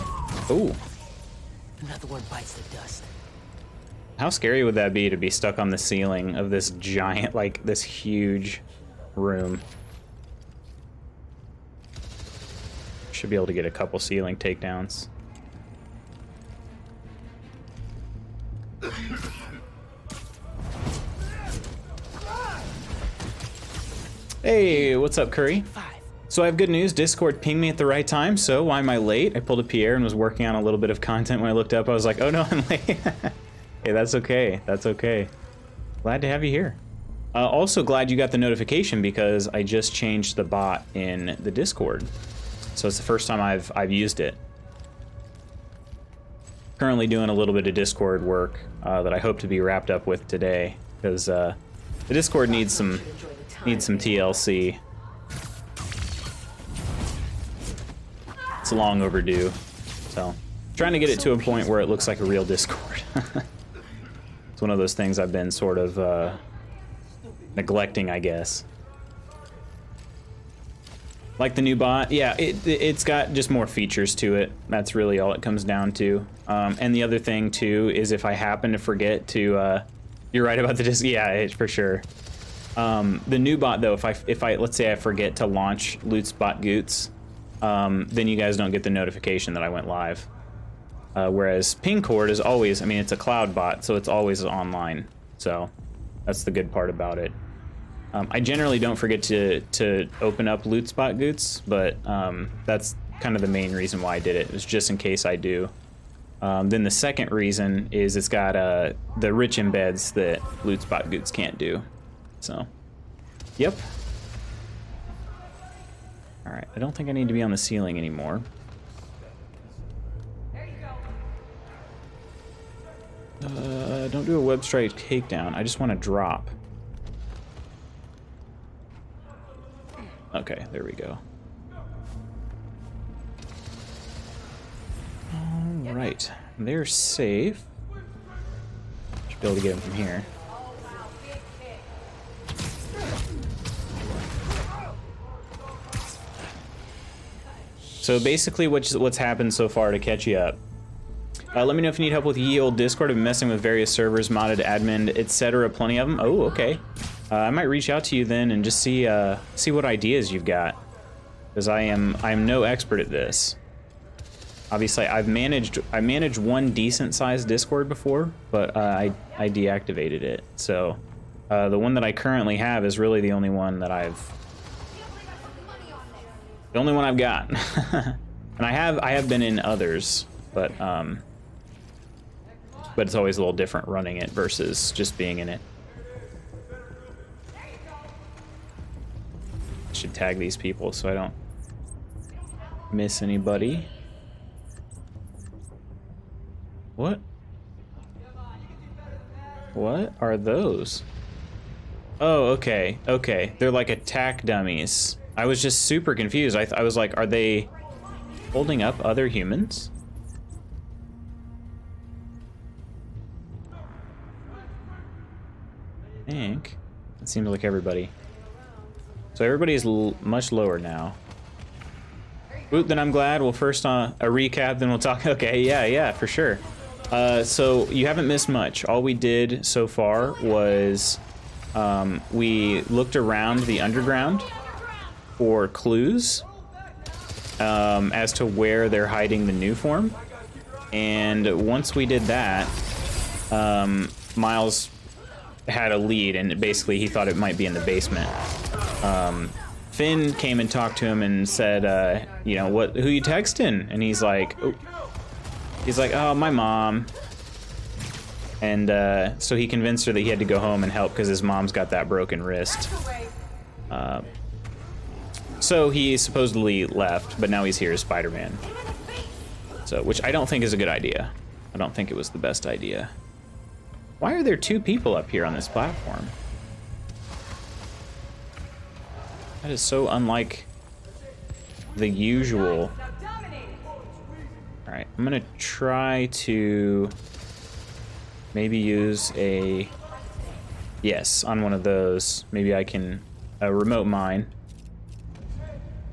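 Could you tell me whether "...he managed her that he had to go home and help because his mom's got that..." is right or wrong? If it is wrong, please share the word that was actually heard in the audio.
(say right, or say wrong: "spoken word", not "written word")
wrong: "convinced", not "managed".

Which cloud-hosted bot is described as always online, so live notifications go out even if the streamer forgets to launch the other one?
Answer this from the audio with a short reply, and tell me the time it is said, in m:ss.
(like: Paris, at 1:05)
Pingcord, at 1:31.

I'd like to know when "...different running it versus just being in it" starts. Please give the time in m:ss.
3:03.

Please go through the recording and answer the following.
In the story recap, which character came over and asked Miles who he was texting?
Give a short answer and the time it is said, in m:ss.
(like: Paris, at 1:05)
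Finn, at 4:09.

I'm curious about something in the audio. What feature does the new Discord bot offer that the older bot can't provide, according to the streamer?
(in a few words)
rich embeds.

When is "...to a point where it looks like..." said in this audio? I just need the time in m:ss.
1:01.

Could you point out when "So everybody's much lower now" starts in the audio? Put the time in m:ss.
3:39.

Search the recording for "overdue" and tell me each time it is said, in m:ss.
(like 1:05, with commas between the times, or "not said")
0:59.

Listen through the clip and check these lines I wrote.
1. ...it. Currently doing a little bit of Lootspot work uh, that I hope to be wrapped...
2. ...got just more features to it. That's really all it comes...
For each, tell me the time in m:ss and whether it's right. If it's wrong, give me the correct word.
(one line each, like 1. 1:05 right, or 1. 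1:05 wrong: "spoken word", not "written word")
1. 0:44 wrong: "Discord", not "Lootspot"
2. 1:13 right.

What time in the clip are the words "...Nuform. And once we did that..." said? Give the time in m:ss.
3:59.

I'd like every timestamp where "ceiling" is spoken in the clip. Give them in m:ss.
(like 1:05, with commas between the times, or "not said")
0:05, 0:13, 1:57.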